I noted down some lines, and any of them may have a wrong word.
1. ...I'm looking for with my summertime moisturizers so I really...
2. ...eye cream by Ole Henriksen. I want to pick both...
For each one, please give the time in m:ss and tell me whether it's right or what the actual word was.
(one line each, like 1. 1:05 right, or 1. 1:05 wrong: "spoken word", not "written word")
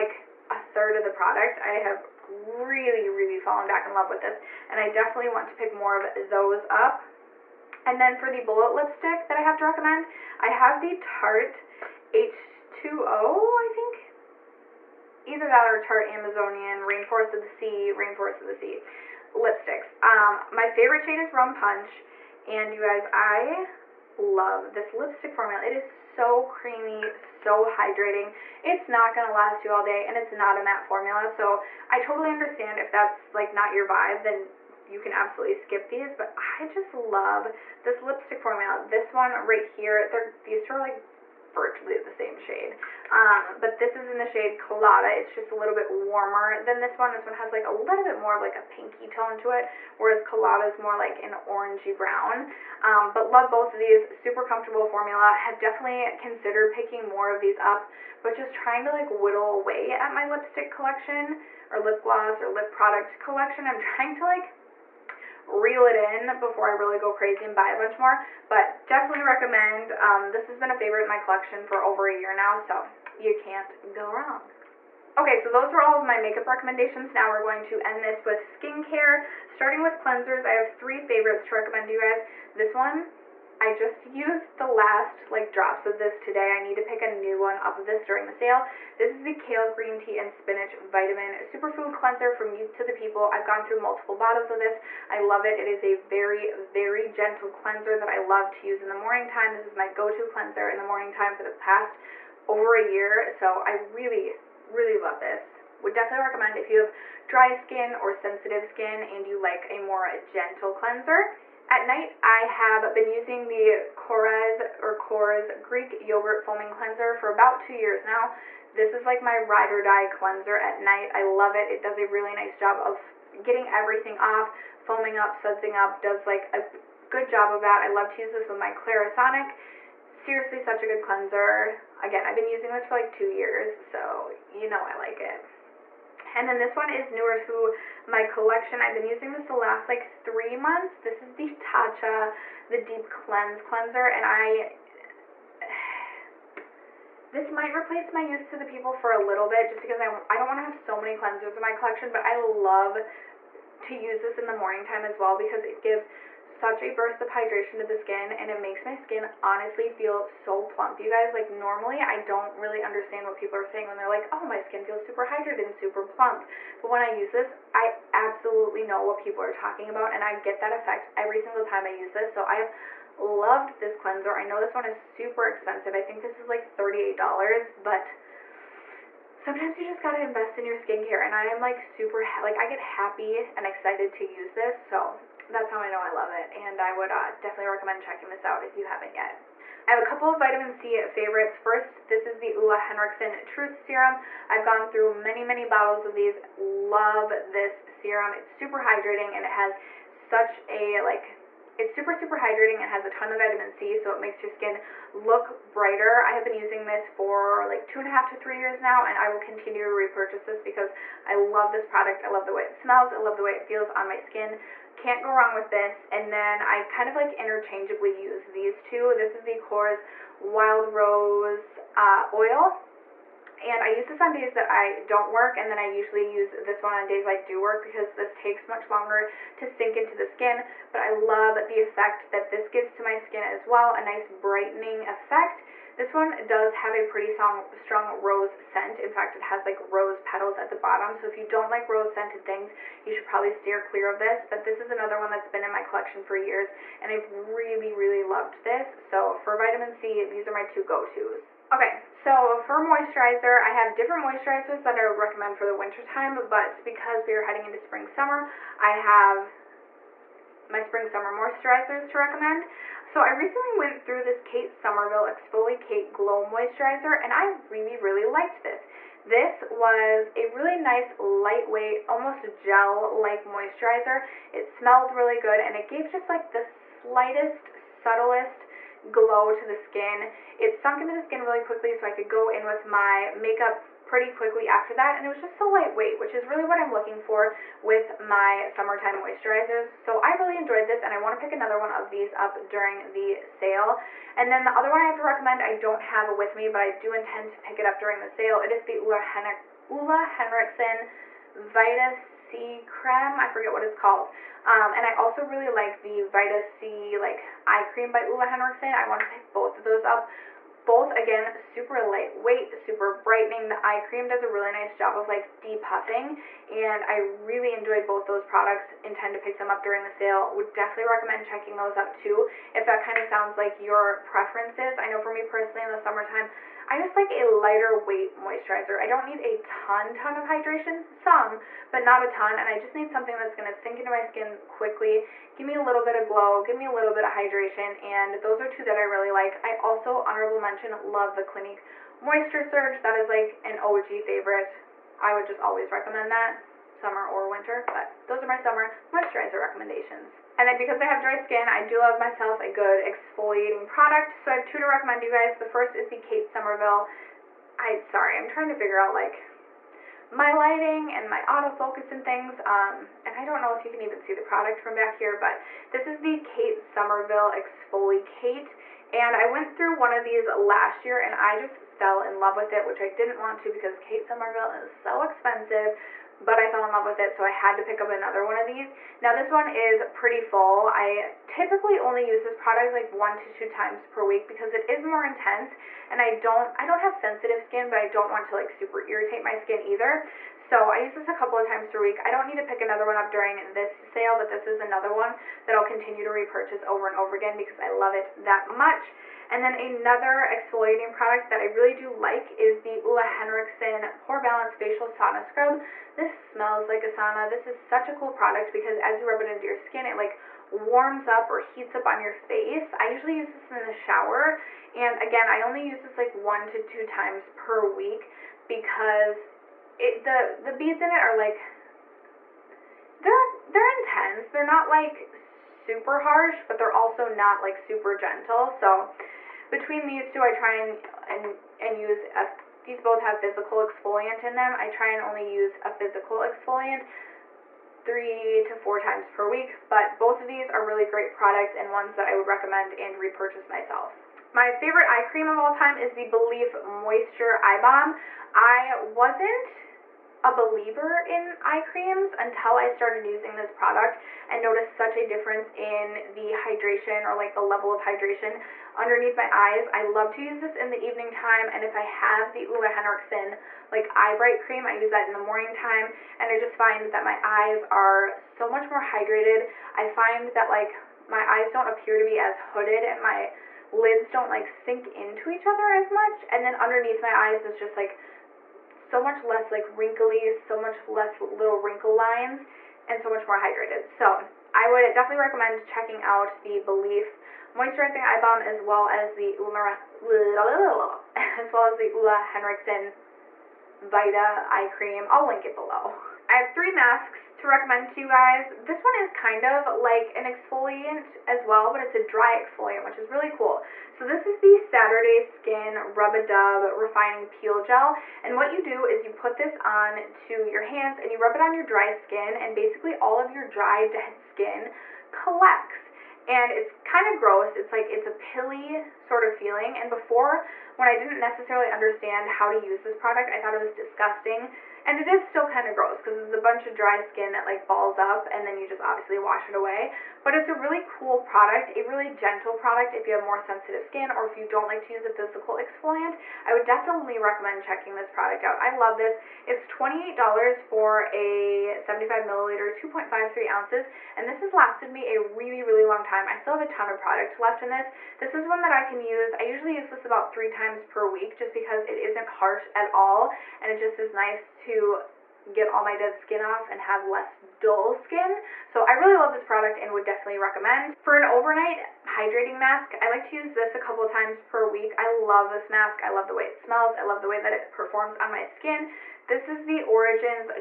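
1. 4:46 right
2. 5:07 right.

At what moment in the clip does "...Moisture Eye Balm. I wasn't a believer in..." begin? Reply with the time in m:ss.
7:26.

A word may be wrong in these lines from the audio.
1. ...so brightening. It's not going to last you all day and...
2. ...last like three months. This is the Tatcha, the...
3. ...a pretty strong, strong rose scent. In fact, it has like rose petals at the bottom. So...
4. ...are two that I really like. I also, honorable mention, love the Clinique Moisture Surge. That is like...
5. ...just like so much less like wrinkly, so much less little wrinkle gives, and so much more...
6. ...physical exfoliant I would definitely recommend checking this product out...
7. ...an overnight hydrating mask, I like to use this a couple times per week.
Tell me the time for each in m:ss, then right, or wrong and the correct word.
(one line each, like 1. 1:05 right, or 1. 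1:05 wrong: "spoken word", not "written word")
1. 0:27 wrong: "hydrating", not "brightening"
2. 2:19 right
3. 3:56 right
4. 5:38 right
5. 7:57 wrong: "lines", not "gives"
6. 8:55 right
7. 9:21 right.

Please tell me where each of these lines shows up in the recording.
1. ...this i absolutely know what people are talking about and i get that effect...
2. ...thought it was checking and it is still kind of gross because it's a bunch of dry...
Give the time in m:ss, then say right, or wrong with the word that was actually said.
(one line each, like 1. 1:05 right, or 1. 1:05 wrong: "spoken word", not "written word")
1. 2:47 right
2. 8:43 wrong: "disgusting", not "checking".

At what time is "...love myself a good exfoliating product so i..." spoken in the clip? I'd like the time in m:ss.
5:51.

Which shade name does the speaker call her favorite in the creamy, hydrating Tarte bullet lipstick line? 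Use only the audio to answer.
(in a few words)
Rum Punch.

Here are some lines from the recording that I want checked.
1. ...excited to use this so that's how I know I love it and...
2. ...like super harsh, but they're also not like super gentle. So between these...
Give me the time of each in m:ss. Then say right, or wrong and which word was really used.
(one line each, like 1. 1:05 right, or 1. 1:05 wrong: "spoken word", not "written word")
1. 3:03 right
2. 7:04 right.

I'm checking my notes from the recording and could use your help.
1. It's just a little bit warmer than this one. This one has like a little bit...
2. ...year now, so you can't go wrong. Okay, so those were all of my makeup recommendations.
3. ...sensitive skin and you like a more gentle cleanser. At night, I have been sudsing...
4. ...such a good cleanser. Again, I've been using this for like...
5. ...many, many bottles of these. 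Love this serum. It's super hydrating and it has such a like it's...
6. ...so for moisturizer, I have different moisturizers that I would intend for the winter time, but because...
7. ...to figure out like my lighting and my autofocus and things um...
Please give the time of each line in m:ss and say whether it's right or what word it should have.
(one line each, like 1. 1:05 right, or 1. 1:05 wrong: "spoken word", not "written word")
1. 0:45 right
2. 1:12 right
3. 1:48 wrong: "using", not "sudsing"
4. 2:10 right
5. 3:15 right
6. 4:12 wrong: "recommend", not "intend"
7. 5:58 right.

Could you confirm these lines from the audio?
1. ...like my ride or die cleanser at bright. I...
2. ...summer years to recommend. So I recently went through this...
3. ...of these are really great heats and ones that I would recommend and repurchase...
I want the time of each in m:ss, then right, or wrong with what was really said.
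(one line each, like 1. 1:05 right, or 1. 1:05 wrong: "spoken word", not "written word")
1. 1:59 wrong: "night", not "bright"
2. 4:21 wrong: "moisturizers", not "years"
3. 7:20 wrong: "products", not "heats".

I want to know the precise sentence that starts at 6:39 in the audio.
And then another exfoliating product that I really do like is the Ole Henriksen Pore Balance Facial Sauna Scrub.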